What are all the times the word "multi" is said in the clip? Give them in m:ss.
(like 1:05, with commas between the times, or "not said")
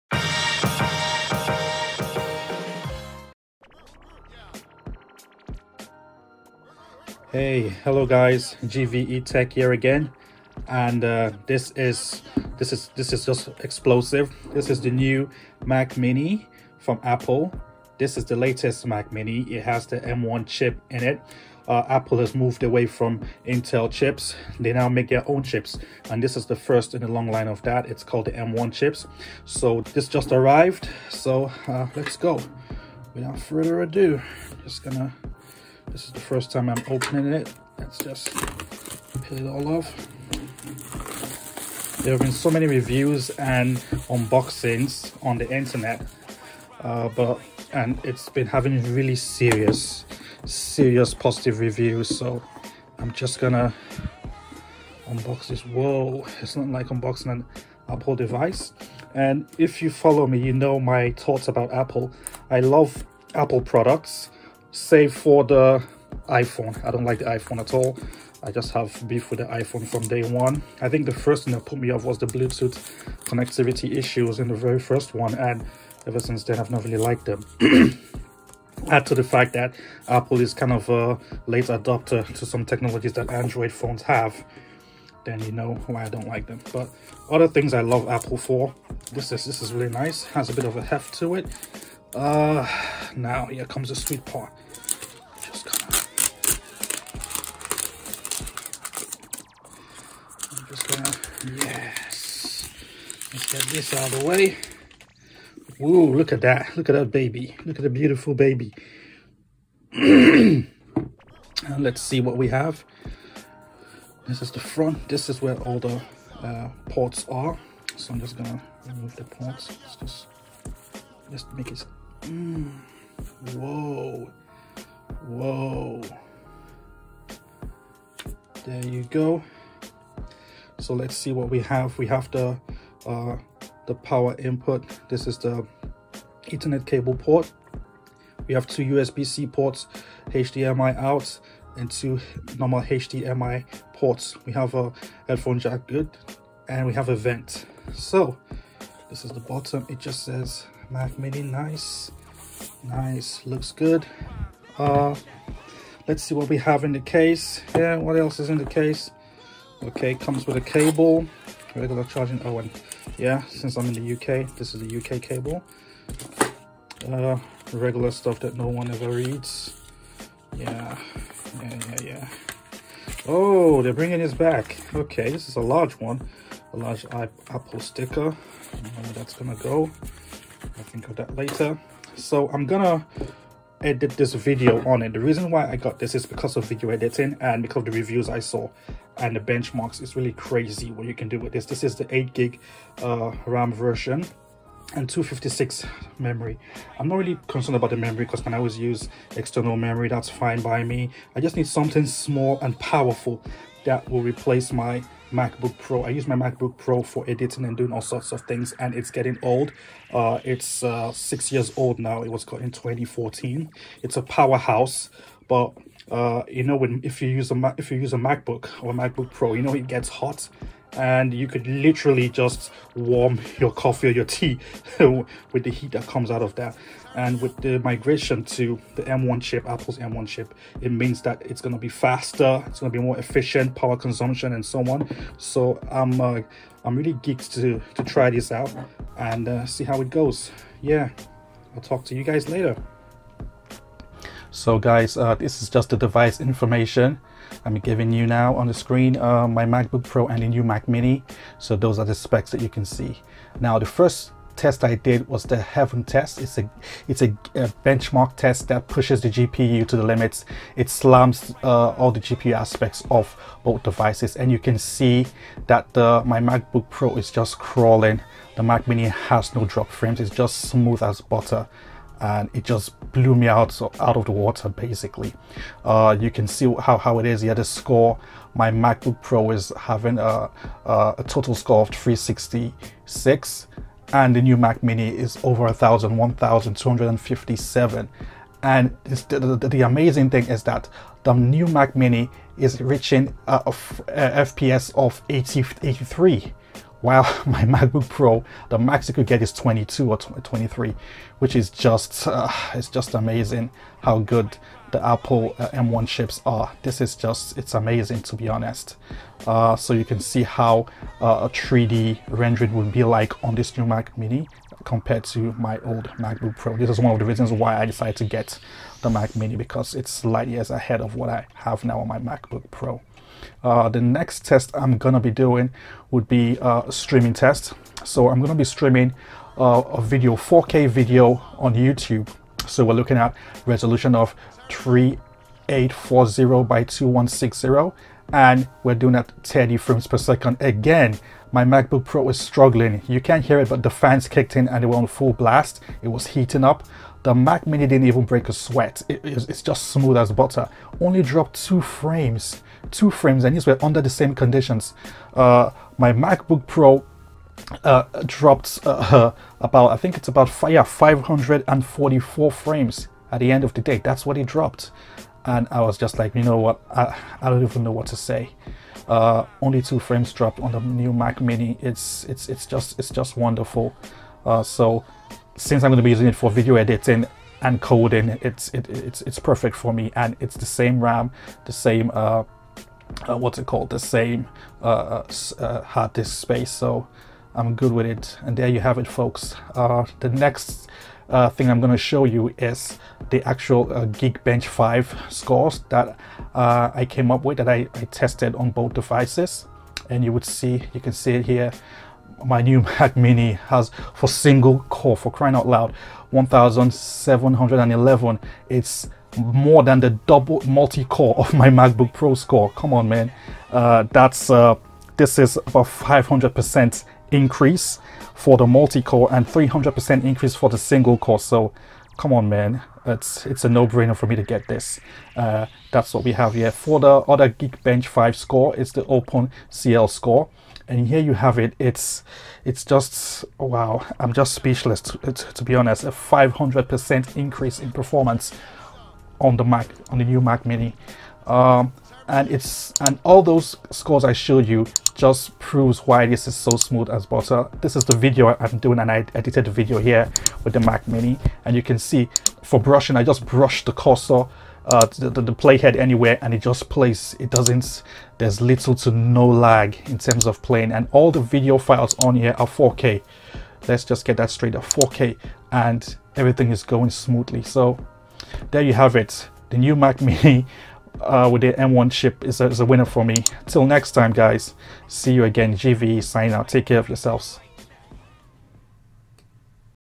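6:50, 6:58.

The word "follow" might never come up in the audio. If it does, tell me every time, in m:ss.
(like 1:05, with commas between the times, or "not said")
0:59.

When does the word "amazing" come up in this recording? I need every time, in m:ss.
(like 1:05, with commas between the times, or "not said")
4:49, 5:03, 5:07.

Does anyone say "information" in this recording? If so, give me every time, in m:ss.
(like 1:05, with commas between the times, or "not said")
4:06.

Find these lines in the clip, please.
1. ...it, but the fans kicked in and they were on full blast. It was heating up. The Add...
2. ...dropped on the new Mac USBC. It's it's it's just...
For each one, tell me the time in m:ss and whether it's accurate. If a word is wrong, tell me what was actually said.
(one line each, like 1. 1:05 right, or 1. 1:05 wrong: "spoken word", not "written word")
1. 5:43 wrong: "Mac", not "Add"
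2. 6:10 wrong: "Mini", not "USBC".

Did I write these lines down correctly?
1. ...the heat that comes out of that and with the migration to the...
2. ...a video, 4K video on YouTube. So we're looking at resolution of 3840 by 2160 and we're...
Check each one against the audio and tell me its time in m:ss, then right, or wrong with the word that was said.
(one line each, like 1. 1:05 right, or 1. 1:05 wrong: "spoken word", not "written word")
1. 3:45 right
2. 5:29 right.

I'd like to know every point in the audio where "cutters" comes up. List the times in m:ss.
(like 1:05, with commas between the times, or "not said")
not said.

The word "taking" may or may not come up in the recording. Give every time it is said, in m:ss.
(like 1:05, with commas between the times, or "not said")
not said.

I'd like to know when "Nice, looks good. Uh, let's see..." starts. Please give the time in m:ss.
2:32.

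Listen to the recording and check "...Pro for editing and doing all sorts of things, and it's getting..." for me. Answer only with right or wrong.
right.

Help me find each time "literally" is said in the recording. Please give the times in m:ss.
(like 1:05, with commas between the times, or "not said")
3:41.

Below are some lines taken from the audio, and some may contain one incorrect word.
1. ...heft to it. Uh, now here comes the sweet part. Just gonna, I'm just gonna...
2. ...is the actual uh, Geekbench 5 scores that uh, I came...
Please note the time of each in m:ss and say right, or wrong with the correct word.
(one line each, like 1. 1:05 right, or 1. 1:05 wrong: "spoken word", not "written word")
1. 1:30 right
2. 6:32 right.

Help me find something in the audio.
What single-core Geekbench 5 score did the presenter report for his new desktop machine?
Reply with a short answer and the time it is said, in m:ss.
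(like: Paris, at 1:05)
1711, at 6:46.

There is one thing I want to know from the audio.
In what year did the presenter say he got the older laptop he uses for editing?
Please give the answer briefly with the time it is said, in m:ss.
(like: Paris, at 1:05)
2014, at 3:32.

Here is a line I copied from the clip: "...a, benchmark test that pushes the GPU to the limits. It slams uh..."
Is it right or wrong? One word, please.
right.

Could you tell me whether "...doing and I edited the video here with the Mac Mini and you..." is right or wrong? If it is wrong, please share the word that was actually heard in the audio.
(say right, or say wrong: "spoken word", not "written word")
right.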